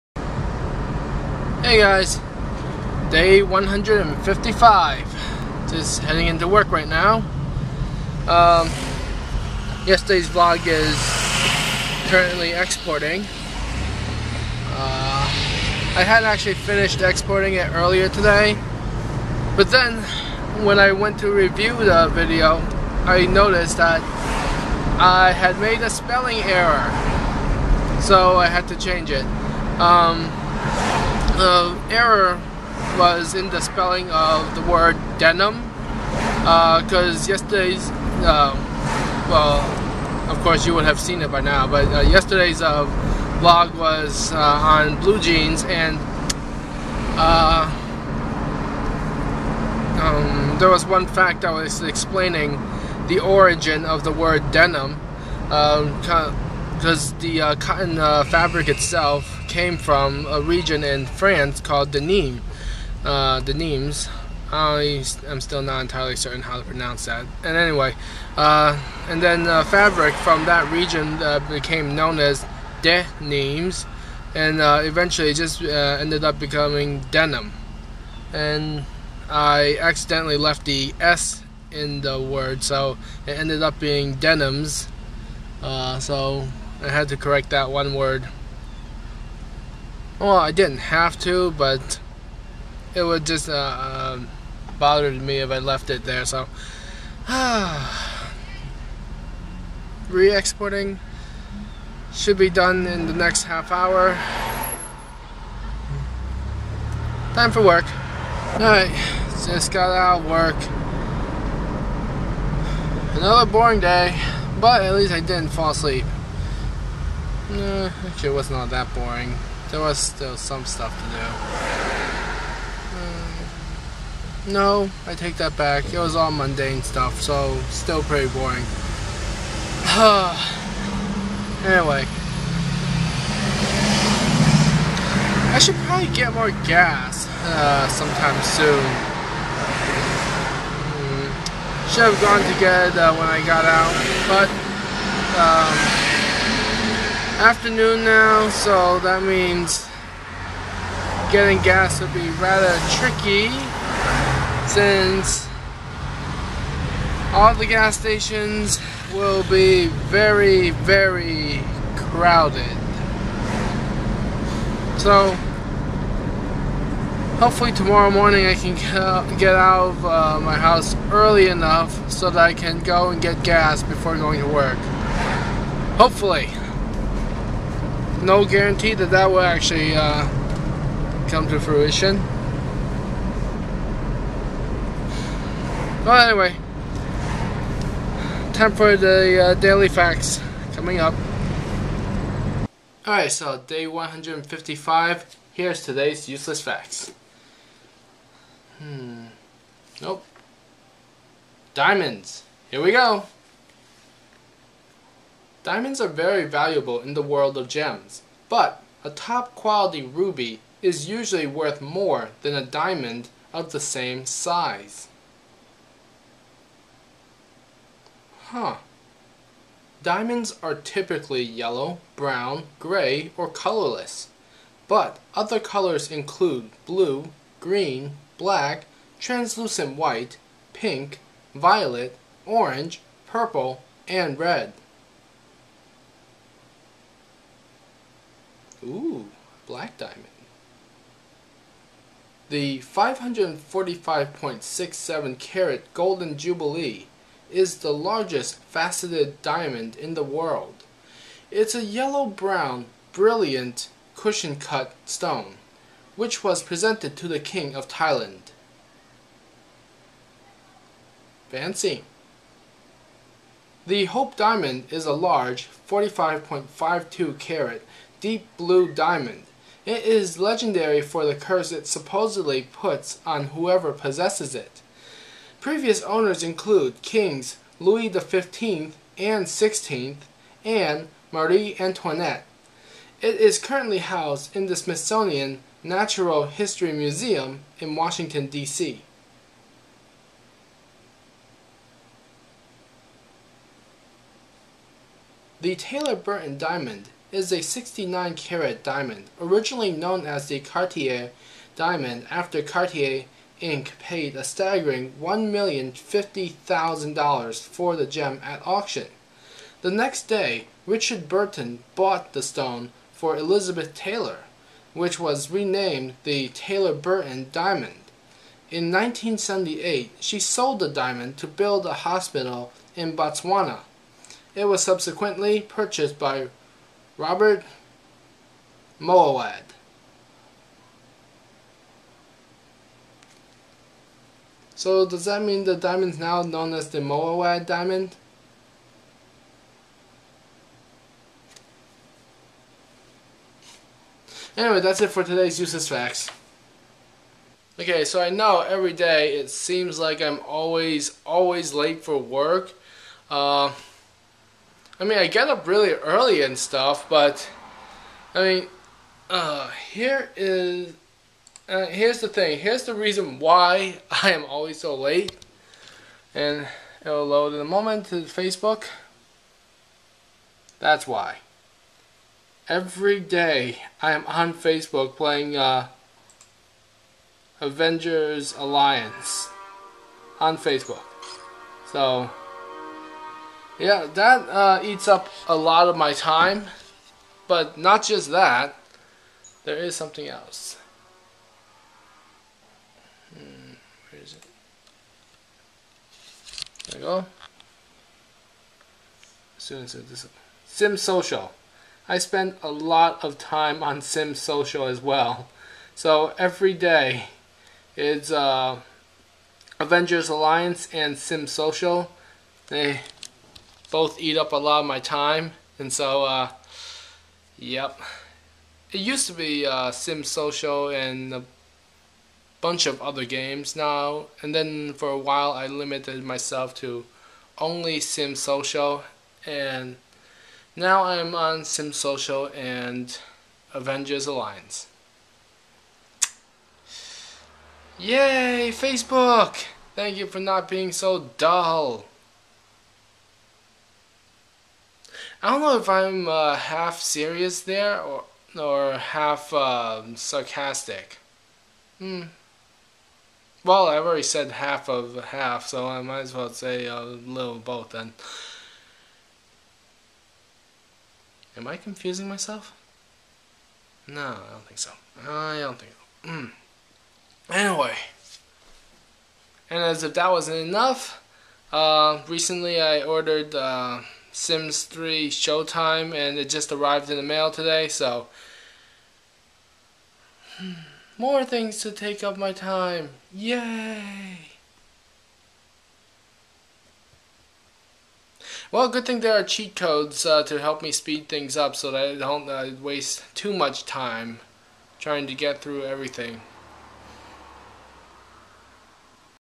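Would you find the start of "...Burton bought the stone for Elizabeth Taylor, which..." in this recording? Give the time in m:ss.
5:11.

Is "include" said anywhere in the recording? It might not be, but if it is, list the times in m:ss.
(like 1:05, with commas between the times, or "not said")
3:46, 4:36.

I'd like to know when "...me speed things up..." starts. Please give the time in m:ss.
8:10.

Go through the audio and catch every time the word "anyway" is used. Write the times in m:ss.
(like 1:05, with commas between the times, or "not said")
1:07, 2:11, 3:06, 5:44, 7:47.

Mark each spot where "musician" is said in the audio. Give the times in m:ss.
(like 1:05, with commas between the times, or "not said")
not said.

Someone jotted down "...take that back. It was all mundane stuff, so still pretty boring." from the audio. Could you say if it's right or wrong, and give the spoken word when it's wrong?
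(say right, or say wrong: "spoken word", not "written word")
right.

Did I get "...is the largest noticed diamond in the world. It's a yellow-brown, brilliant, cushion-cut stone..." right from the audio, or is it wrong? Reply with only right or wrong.
wrong.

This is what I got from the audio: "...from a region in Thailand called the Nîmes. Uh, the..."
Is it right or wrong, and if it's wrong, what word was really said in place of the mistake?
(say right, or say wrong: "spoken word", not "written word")
wrong: "France", not "Thailand".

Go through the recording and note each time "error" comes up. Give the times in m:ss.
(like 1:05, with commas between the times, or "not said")
0:26, 0:31.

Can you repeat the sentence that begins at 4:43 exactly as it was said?
It is currently housed in the Smithsonian Natural History Museum in Washington, D.C.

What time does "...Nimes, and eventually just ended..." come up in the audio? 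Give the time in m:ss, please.
1:13.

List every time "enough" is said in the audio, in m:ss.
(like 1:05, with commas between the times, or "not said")
2:51, 7:50.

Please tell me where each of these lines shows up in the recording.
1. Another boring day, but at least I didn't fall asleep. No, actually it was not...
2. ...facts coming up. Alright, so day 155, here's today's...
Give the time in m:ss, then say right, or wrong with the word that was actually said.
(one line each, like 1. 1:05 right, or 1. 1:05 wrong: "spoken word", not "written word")
1. 1:53 right
2. 3:09 right.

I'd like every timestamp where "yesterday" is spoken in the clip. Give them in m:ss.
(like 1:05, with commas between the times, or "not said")
0:09, 0:37, 0:42.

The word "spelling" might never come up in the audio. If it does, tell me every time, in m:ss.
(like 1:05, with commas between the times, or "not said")
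0:25, 0:33.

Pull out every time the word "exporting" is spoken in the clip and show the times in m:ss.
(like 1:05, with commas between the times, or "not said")
0:12, 0:17, 1:40.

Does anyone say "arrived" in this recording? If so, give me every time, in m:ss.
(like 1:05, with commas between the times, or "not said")
7:56.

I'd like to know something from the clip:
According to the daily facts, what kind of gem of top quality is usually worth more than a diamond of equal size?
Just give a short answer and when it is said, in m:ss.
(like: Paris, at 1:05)
ruby, at 3:30.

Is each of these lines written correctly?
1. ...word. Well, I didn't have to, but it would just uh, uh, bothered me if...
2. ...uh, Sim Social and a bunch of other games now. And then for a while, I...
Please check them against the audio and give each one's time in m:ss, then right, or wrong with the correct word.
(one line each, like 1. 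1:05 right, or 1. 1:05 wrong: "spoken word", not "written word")
1. 1:27 right
2. 6:59 right.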